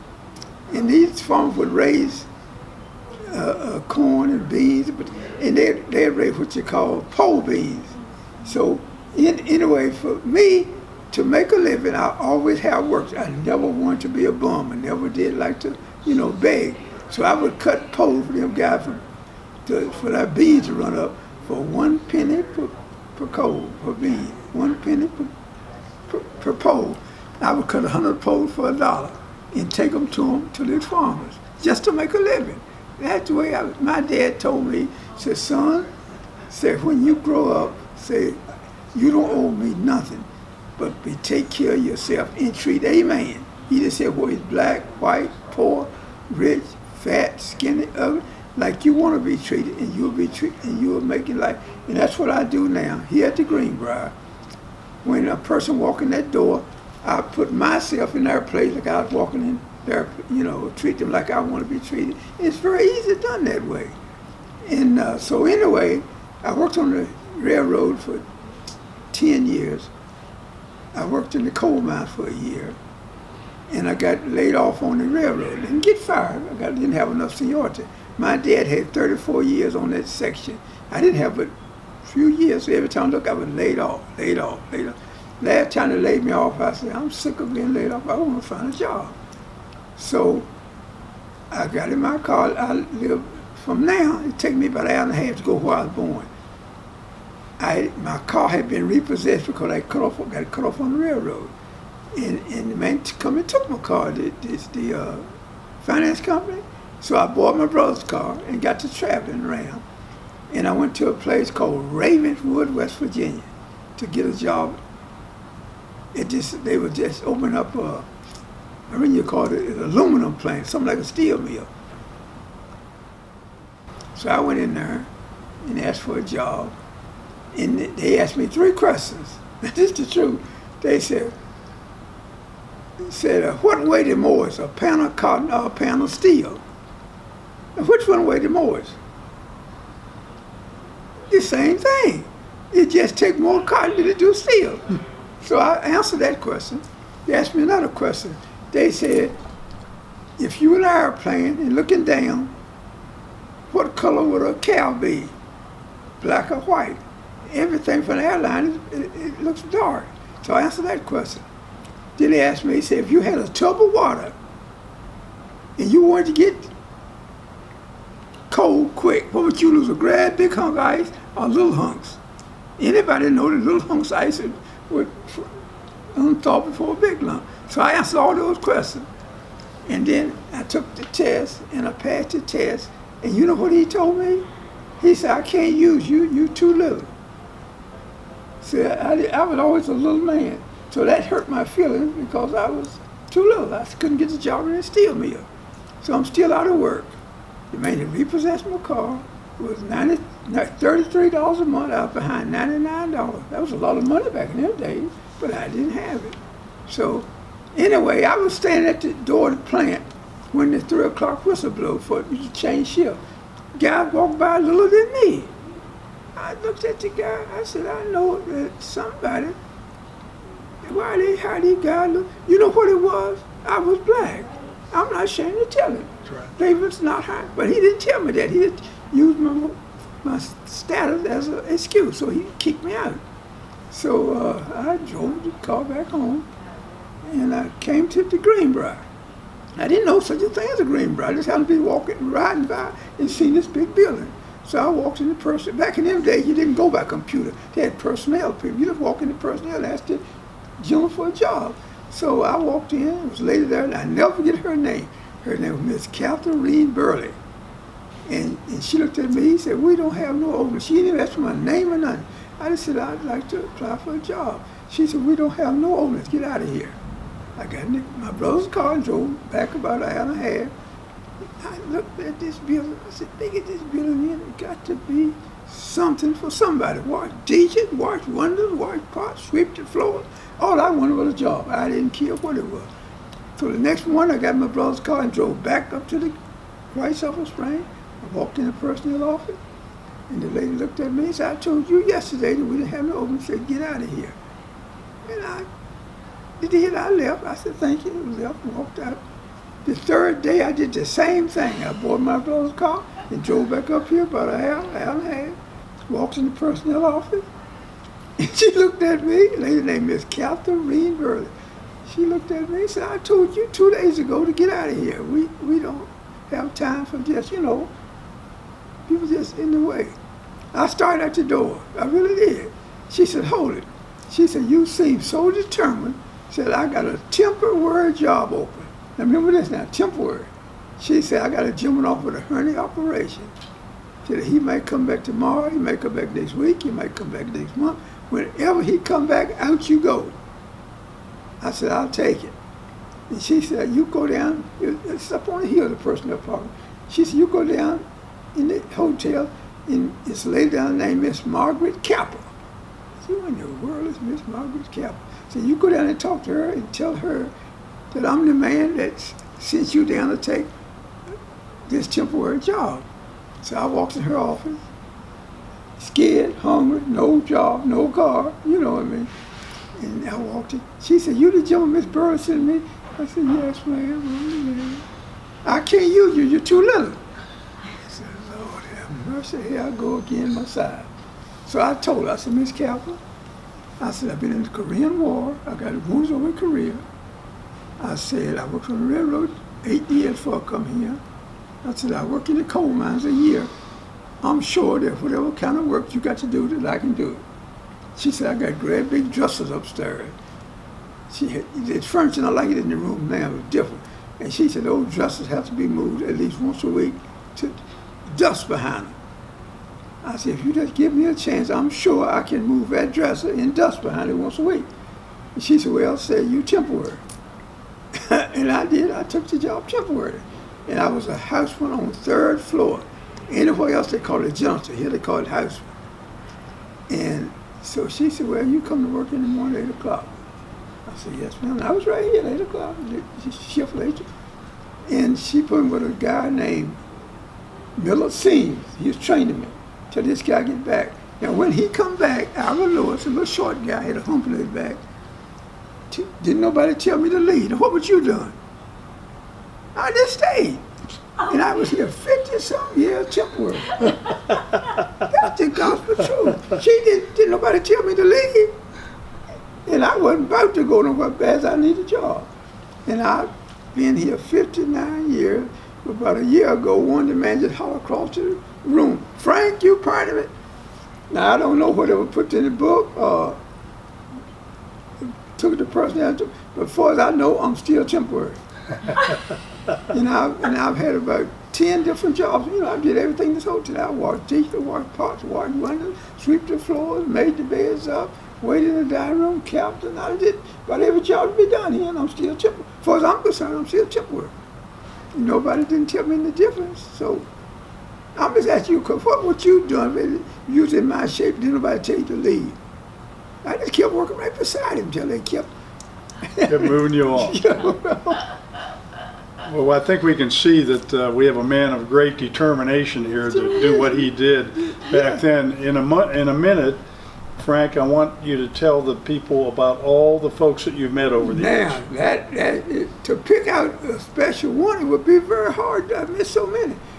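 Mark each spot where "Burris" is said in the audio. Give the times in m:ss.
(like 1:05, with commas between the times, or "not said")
6:12.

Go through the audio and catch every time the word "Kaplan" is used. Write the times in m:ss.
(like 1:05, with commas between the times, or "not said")
6:22.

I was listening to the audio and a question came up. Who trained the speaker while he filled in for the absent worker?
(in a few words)
Miller Seams.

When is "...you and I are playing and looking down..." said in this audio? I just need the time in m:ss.
2:30.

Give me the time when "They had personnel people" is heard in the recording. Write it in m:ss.
4:07.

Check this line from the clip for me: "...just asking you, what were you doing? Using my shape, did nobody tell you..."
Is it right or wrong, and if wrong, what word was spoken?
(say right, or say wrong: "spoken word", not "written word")
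right.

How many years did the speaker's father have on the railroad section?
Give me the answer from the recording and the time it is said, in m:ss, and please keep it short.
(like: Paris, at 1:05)
34, at 1:18.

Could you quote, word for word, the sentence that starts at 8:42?
That, that, to pick out a special one, it would be very hard.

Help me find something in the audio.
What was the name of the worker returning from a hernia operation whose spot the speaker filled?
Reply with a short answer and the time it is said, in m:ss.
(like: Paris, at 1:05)
Alvin Lewis, at 7:22.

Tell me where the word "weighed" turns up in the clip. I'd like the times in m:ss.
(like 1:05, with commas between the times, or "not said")
2:13, 2:18.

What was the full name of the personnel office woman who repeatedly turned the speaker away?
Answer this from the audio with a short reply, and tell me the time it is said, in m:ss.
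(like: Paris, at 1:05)
Catherine Reed Burley, at 4:16.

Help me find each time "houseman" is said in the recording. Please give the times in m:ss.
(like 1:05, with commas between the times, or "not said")
7:01, 7:05.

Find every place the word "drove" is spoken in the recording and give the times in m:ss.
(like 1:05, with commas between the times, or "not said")
3:55, 4:29, 4:45, 5:03.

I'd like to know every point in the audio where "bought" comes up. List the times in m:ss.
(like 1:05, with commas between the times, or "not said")
1:47, 5:01.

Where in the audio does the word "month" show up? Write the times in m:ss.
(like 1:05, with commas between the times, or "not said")
3:21, 5:37.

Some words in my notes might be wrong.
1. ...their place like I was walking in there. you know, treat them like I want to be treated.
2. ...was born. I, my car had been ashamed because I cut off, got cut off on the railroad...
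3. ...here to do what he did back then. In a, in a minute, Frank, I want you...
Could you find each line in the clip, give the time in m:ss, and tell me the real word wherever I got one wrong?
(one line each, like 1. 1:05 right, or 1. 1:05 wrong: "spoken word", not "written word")
1. 0:58 right
2. 1:35 wrong: "repossessed", not "ashamed"
3. 8:33 right.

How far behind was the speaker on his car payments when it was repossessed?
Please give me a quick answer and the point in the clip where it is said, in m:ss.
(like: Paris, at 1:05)
$99, at 3:22.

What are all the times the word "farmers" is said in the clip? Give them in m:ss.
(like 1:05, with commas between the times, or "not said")
0:01, 0:30.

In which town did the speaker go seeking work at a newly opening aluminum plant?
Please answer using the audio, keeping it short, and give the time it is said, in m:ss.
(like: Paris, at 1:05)
Ravenswood, West Virginia, at 1:51.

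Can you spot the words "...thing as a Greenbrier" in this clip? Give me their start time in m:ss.
4:00.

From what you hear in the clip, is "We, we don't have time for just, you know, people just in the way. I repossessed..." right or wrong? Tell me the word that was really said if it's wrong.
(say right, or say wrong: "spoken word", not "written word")
wrong: "started", not "repossessed".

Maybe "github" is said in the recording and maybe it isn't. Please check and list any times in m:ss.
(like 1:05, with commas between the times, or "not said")
not said.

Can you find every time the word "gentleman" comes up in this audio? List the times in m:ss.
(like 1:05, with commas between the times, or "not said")
5:31, 6:11.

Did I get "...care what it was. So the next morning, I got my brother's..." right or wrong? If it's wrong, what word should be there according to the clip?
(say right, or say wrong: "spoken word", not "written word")
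right.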